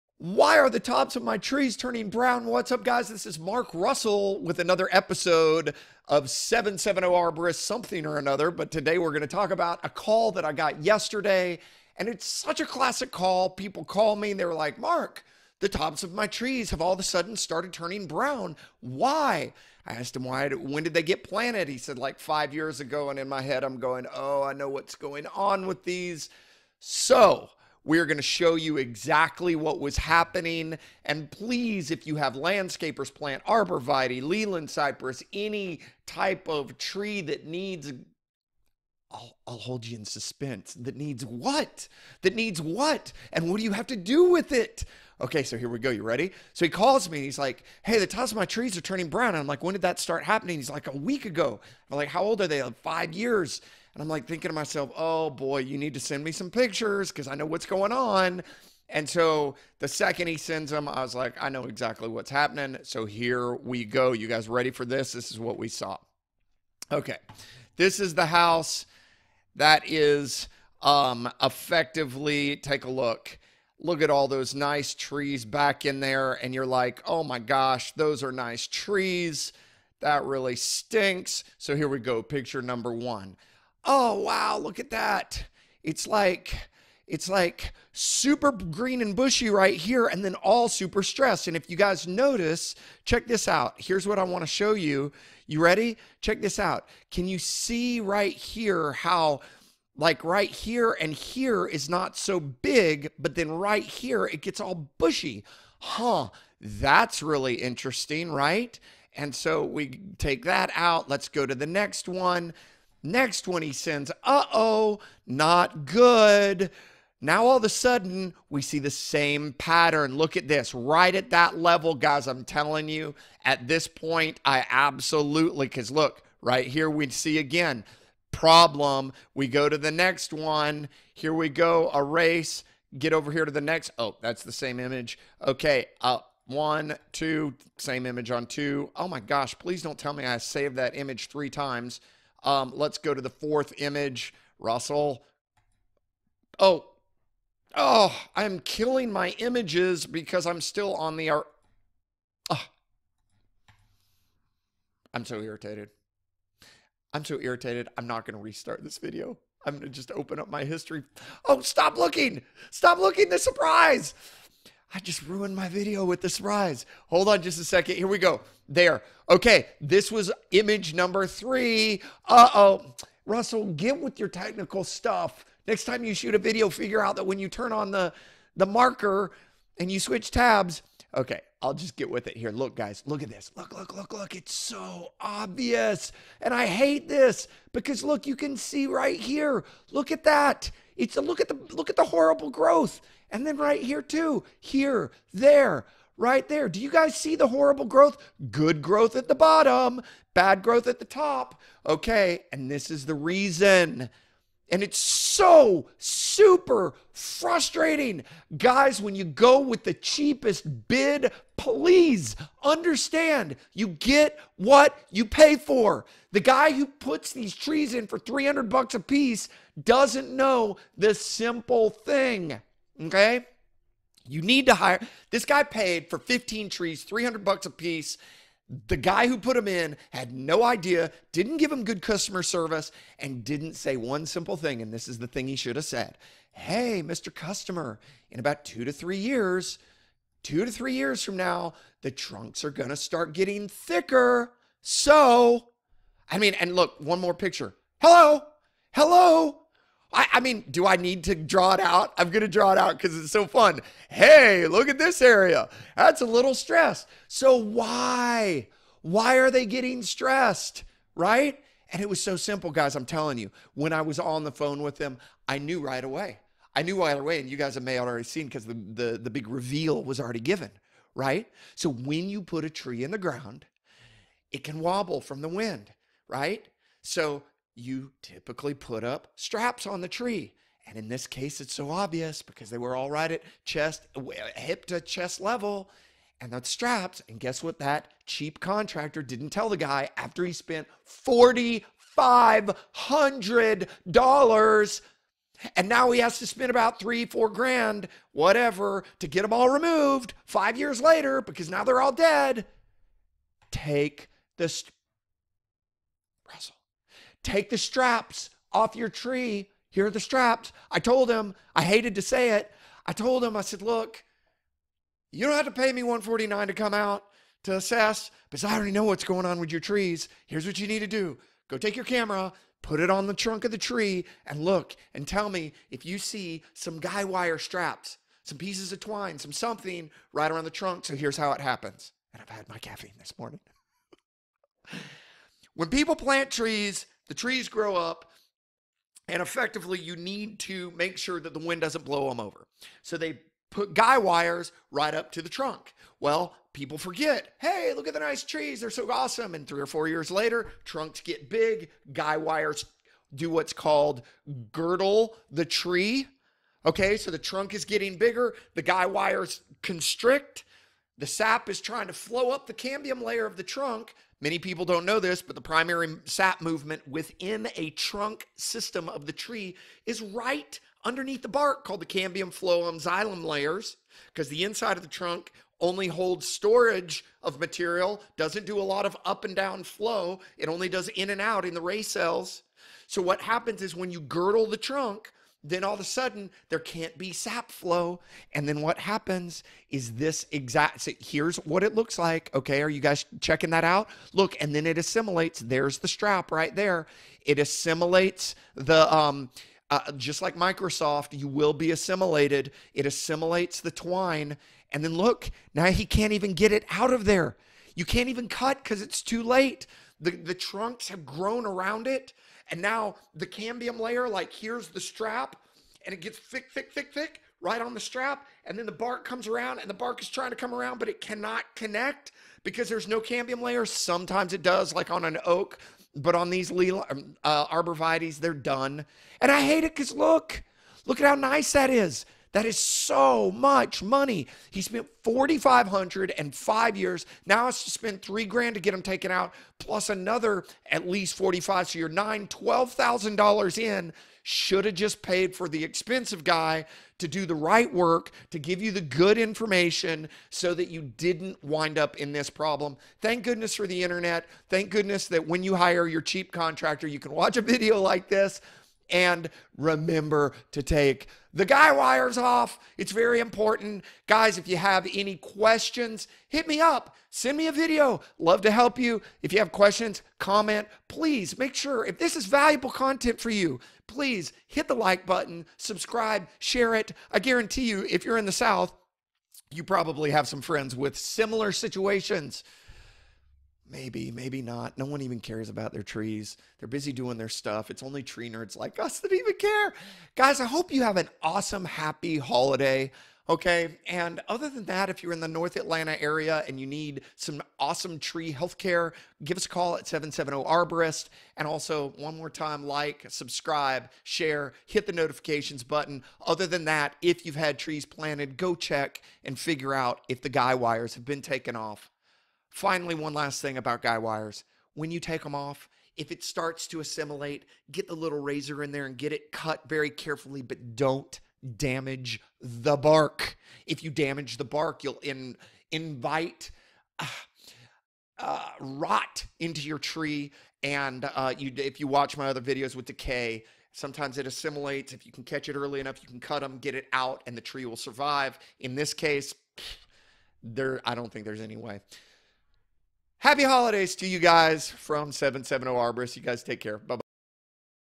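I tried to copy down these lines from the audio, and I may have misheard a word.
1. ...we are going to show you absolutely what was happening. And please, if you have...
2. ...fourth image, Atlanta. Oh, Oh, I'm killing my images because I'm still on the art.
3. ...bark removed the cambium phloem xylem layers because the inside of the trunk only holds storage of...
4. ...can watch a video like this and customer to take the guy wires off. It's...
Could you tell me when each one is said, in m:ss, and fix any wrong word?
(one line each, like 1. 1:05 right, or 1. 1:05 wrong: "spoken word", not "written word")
1. 0:27 wrong: "exactly", not "absolutely"
2. 2:23 wrong: "Russell", not "Atlanta"
3. 6:11 wrong: "called", not "removed"
4. 7:37 wrong: "remember", not "customer".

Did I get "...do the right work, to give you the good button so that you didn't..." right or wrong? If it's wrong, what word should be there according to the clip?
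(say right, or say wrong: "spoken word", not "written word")
wrong: "information", not "button".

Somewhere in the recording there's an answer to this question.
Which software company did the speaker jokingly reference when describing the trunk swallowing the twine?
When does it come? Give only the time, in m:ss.
6:40.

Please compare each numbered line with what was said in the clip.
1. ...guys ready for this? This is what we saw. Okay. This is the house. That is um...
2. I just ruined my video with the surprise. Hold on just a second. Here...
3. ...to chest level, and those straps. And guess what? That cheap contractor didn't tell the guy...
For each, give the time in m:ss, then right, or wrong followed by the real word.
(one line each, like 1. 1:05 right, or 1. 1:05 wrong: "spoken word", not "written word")
1. 1:04 right
2. 2:44 right
3. 4:44 right.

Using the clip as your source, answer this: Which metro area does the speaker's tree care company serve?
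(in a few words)
North Atlanta.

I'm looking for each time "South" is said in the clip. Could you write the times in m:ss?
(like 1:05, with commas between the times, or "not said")
7:58.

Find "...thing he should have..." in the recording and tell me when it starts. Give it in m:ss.
3:55.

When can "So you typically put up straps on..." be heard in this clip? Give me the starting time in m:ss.
4:37.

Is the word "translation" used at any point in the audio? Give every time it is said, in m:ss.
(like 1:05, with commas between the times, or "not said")
not said.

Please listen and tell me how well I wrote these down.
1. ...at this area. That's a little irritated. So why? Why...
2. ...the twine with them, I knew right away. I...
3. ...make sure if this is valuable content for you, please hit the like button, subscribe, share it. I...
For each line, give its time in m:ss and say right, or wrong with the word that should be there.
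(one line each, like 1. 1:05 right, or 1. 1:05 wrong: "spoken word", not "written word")
1. 4:14 wrong: "stressed", not "irritated"
2. 4:24 wrong: "phone", not "twine"
3. 7:51 right.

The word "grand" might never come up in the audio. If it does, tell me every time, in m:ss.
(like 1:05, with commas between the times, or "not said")
4:57, 7:18.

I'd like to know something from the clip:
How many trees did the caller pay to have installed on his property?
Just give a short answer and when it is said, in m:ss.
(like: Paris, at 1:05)
15, at 3:46.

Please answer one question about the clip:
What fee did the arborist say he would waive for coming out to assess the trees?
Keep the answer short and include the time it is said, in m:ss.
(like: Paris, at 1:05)
149, at 5:16.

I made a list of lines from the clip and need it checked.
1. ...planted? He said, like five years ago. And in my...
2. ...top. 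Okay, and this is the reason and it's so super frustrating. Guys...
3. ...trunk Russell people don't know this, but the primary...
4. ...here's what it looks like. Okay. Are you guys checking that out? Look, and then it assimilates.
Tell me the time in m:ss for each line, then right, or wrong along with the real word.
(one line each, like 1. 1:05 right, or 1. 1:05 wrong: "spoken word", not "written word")
1. 0:21 right
2. 3:21 right
3. 6:03 wrong: "Many", not "Russell"
4. 6:31 right.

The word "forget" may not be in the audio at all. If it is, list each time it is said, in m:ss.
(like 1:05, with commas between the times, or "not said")
5:46.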